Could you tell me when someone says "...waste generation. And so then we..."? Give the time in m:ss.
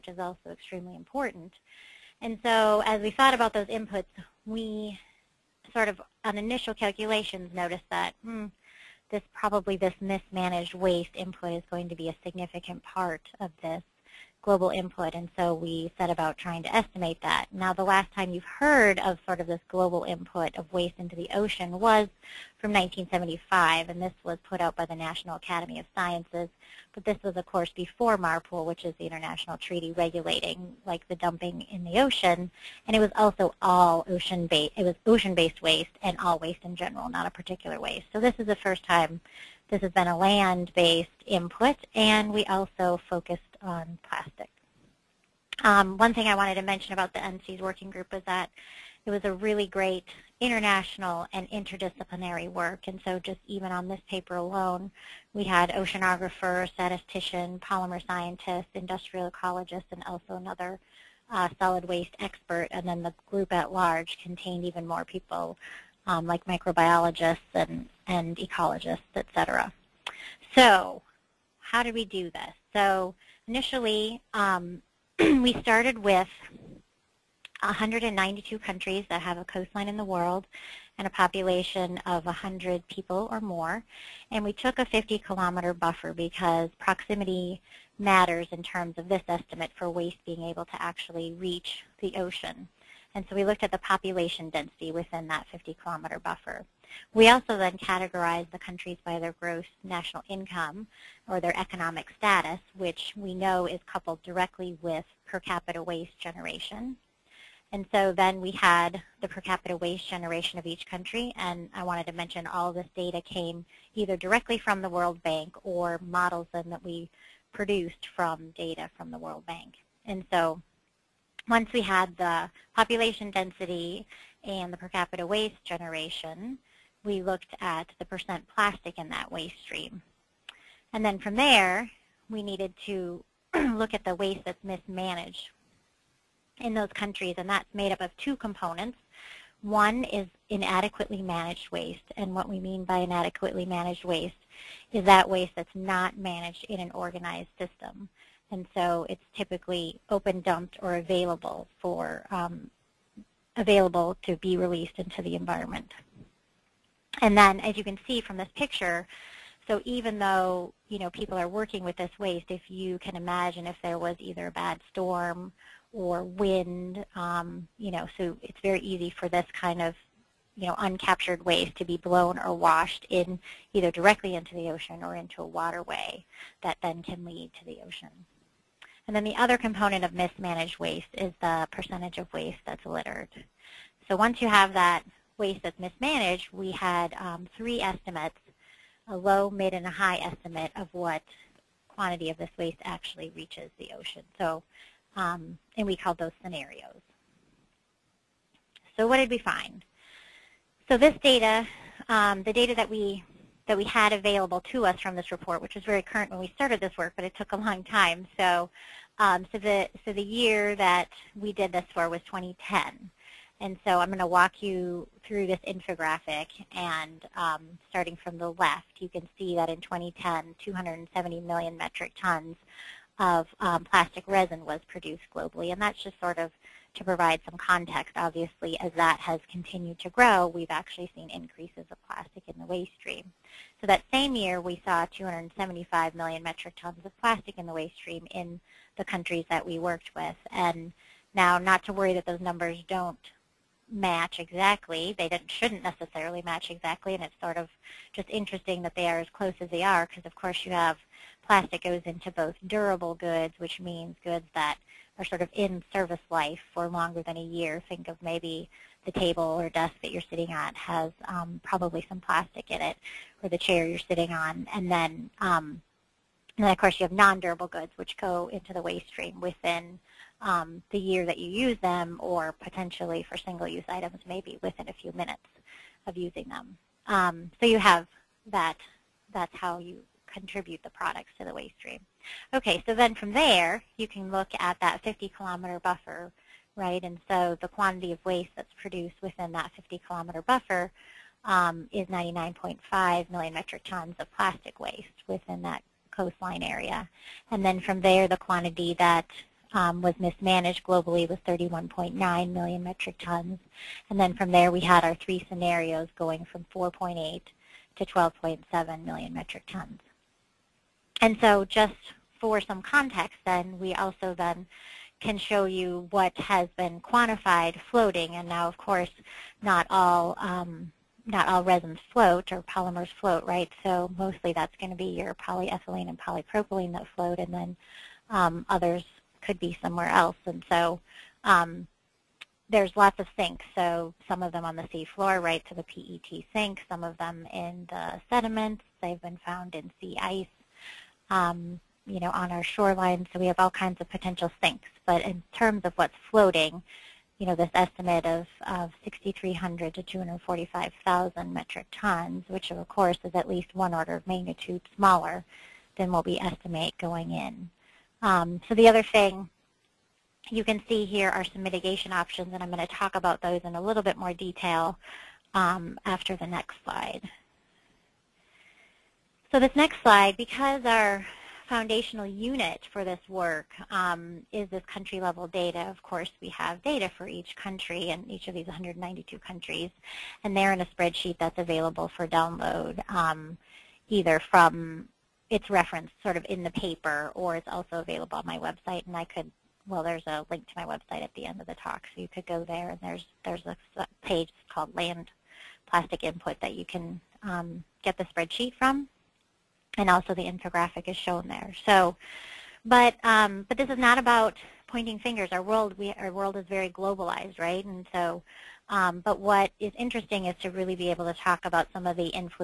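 1:45.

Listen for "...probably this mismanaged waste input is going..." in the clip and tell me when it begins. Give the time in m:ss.
0:09.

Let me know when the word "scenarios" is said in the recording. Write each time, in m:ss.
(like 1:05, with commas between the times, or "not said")
3:16, 5:05.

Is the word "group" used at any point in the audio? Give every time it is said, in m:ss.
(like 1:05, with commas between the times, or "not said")
0:47, 1:03.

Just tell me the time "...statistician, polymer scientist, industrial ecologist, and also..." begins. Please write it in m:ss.
0:56.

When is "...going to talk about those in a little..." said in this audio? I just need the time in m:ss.
6:02.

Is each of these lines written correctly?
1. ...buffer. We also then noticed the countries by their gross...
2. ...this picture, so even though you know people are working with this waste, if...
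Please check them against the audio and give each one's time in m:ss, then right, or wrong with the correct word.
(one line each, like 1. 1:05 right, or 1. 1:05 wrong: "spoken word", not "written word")
1. 1:36 wrong: "categorized", not "noticed"
2. 2:38 right.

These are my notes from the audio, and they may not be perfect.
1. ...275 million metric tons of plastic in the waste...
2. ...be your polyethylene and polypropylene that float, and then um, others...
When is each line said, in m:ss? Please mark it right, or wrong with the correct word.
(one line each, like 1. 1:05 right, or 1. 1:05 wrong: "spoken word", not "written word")
1. 3:55 right
2. 5:24 right.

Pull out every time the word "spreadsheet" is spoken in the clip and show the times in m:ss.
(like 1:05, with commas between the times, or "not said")
6:20, 6:38.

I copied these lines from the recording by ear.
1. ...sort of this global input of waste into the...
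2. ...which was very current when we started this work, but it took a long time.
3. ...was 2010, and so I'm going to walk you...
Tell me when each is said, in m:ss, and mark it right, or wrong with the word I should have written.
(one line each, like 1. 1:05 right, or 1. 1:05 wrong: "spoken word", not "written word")
1. 0:19 right
2. 3:25 right
3. 3:32 right.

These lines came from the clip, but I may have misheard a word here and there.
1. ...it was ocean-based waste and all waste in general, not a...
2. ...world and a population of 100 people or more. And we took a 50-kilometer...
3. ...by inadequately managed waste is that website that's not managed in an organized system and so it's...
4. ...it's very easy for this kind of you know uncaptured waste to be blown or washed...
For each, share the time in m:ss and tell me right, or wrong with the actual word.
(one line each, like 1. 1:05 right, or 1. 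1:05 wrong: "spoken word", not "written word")
1. 0:34 right
2. 1:20 right
3. 2:22 wrong: "waste", not "website"
4. 2:48 right.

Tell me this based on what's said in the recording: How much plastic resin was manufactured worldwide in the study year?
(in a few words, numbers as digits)
270 million metric tons.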